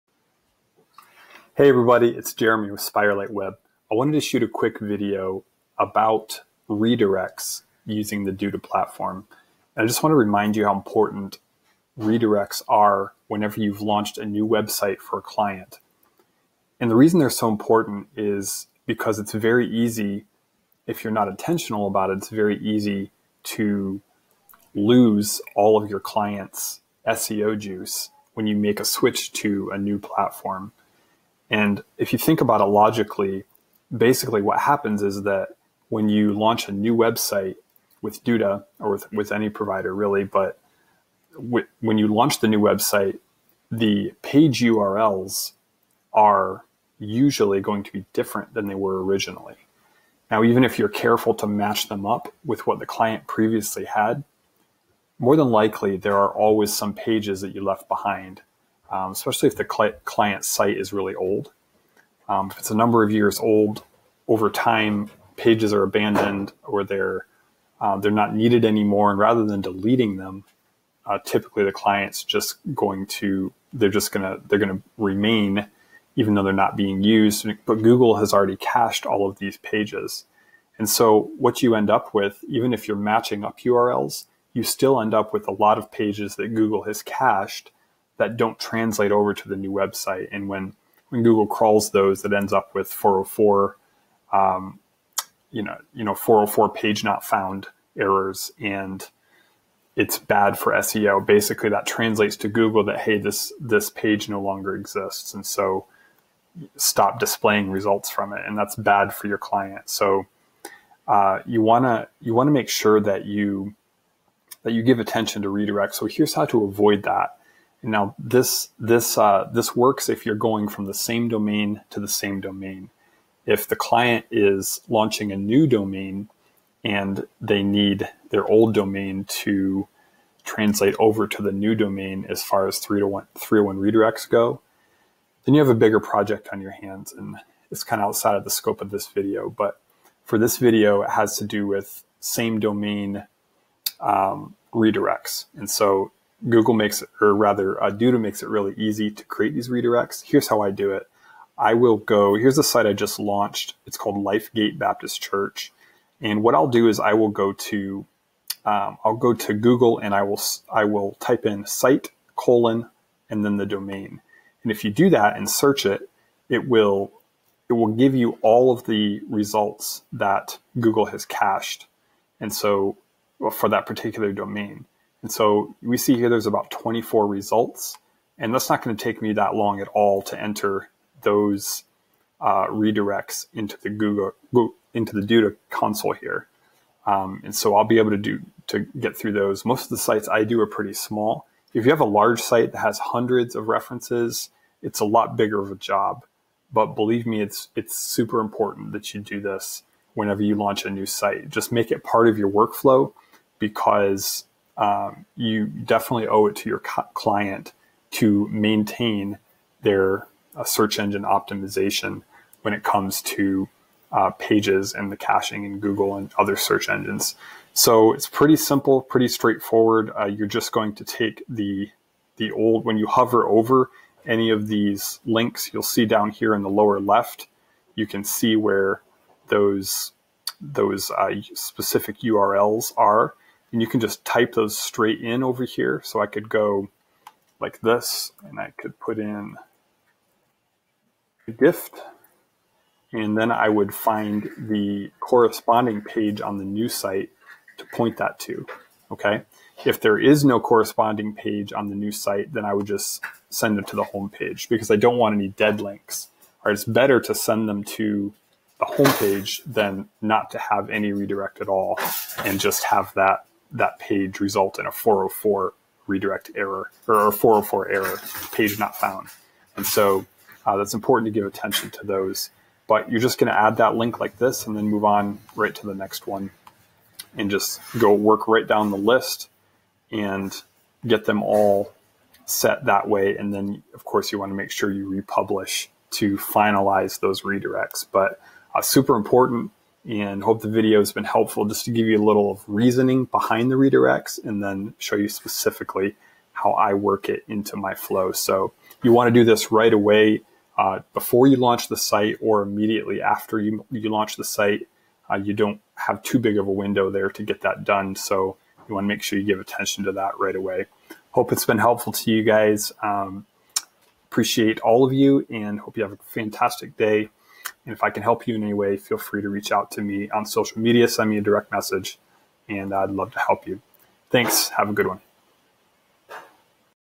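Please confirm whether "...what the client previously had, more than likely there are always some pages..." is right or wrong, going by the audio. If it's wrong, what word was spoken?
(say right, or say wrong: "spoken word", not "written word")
right.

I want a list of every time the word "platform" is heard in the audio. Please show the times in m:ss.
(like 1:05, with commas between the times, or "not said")
0:08, 0:29.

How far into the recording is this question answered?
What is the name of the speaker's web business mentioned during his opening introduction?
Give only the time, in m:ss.
0:02.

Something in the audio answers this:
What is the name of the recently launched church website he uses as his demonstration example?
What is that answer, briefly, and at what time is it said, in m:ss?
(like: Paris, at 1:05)
LifeGate Baptist Church, at 2:34.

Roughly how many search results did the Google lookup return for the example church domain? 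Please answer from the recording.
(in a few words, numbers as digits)
24.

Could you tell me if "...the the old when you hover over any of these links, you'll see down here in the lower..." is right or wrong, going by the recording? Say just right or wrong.
right.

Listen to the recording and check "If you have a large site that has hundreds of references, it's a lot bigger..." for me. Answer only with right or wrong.
right.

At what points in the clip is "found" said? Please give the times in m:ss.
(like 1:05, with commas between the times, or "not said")
1:37, 4:28.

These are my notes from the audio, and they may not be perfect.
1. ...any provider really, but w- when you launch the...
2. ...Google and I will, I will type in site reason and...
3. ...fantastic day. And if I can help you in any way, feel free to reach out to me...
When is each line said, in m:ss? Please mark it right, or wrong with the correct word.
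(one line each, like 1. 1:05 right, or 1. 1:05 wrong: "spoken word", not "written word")
1. 0:39 right
2. 2:39 wrong: "colon", not "reason"
3. 5:16 right.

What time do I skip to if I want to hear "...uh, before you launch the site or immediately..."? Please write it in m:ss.
5:00.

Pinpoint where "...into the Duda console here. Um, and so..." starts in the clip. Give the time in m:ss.
3:04.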